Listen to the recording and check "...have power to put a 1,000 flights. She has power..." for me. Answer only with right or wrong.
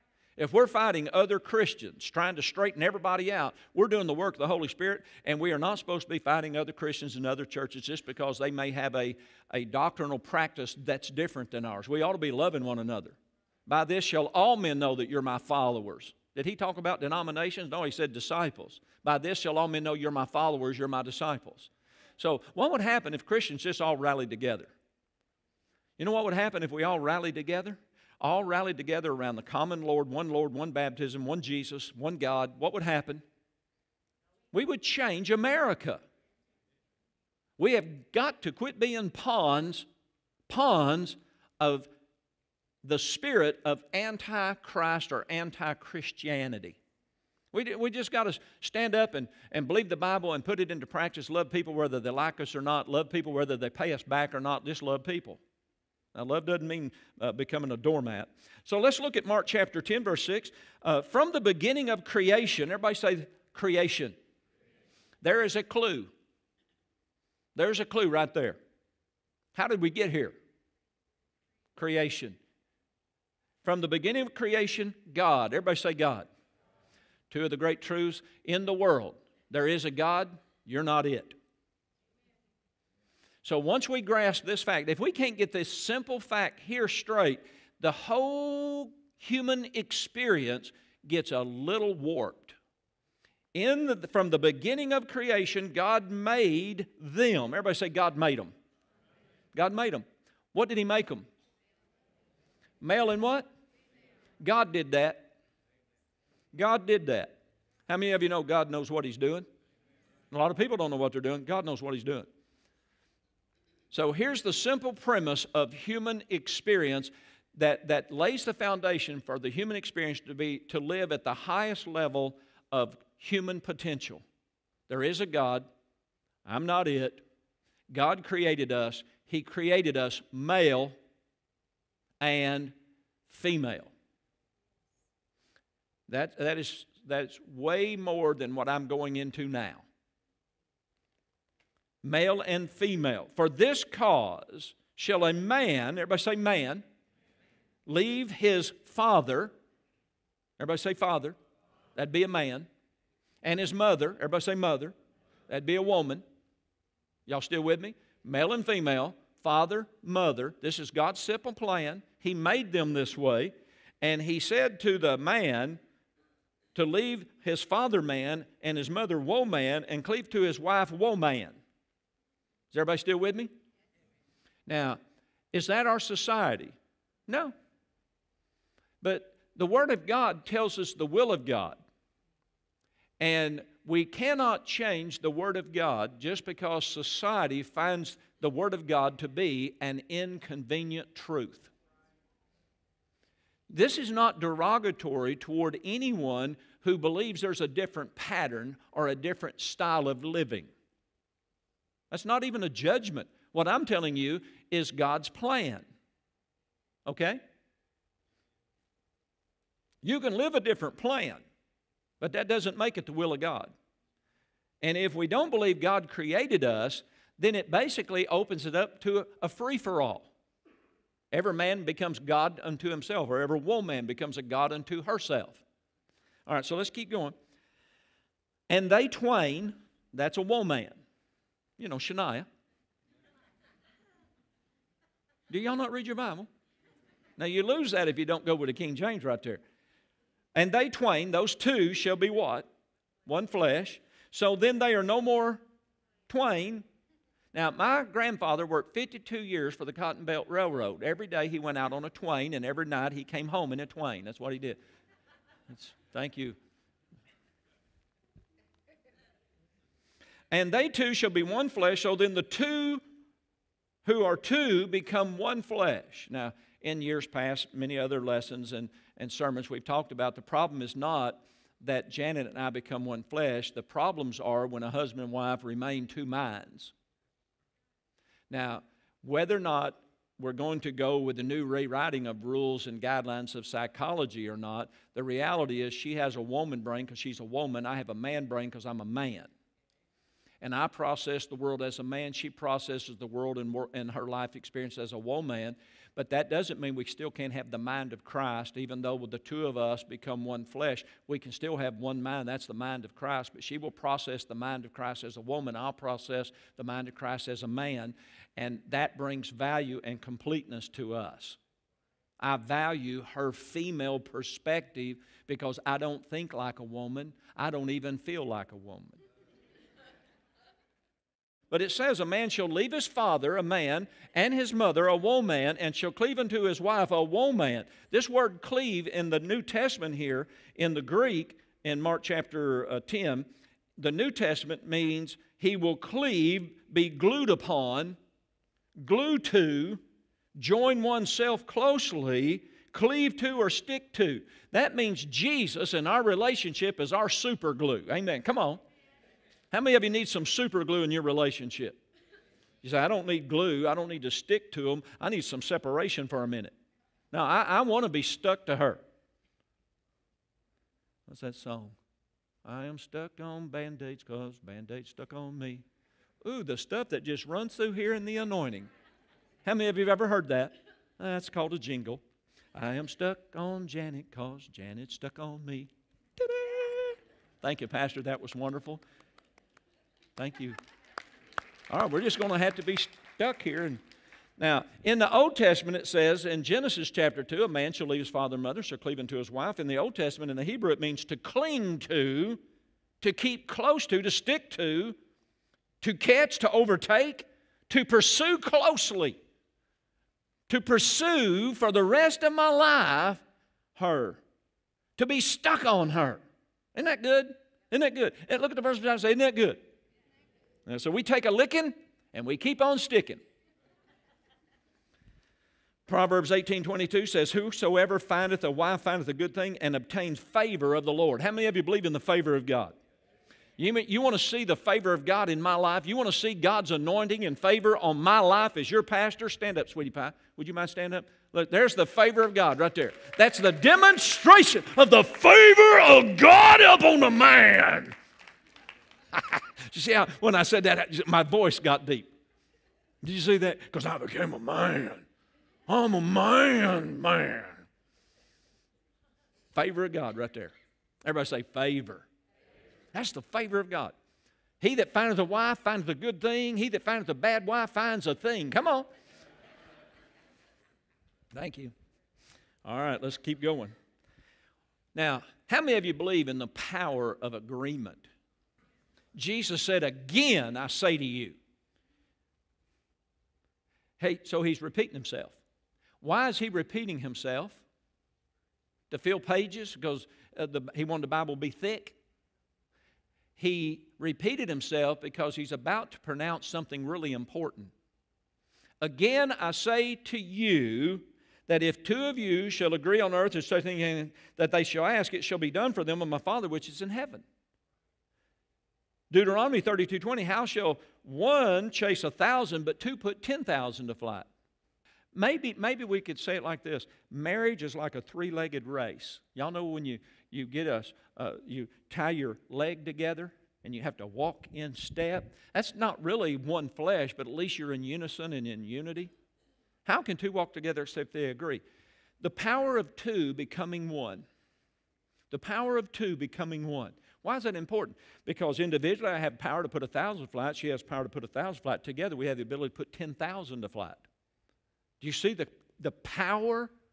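right.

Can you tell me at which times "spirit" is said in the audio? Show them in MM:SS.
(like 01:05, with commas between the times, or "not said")
00:04, 00:42.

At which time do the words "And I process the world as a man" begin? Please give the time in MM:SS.
04:50.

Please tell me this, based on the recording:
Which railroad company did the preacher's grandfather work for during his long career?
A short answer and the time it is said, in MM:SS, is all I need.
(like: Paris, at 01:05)
Cotton Belt Railroad, at 04:09.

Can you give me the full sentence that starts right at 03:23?
What I'm telling you is God's plan.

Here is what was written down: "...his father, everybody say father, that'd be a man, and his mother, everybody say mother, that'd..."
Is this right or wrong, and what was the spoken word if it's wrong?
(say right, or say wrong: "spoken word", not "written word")
right.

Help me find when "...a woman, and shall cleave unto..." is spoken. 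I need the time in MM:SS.
05:25.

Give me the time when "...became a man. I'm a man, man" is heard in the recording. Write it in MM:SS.
07:24.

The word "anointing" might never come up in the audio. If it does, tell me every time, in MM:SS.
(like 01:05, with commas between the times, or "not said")
06:08, 07:06.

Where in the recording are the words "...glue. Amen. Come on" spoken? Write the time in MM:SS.
05:47.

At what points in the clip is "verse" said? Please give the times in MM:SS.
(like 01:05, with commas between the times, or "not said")
01:00, 06:48.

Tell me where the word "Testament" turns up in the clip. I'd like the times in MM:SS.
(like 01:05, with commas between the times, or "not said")
05:29, 05:34, 06:25, 06:30.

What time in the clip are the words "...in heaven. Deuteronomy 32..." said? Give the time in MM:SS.
08:17.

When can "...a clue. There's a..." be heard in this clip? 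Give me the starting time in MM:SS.
01:05.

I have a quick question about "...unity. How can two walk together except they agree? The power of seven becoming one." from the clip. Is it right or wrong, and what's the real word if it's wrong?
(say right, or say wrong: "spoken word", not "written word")
wrong: "two", not "seven".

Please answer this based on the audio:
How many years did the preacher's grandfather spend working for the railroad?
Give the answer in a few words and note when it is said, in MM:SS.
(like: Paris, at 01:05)
52, at 04:08.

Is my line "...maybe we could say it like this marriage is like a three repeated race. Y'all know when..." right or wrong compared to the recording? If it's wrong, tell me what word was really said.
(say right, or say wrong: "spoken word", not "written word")
wrong: "legged", not "repeated".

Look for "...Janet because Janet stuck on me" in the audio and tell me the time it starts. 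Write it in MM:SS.
06:13.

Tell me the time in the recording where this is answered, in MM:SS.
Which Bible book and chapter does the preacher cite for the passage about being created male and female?
00:59.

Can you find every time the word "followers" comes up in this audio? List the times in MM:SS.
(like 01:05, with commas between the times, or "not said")
00:15, 00:20.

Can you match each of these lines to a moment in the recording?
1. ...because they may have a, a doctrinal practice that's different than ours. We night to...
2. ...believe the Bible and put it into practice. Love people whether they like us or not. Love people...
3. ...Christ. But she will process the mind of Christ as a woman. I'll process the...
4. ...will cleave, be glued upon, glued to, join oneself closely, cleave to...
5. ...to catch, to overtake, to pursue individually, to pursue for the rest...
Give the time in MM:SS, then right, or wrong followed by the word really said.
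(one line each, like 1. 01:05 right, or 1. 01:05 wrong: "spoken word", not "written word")
1. 00:08 wrong: "ought", not "night"
2. 00:49 right
3. 05:03 right
4. 05:35 right
5. 06:36 wrong: "closely", not "individually".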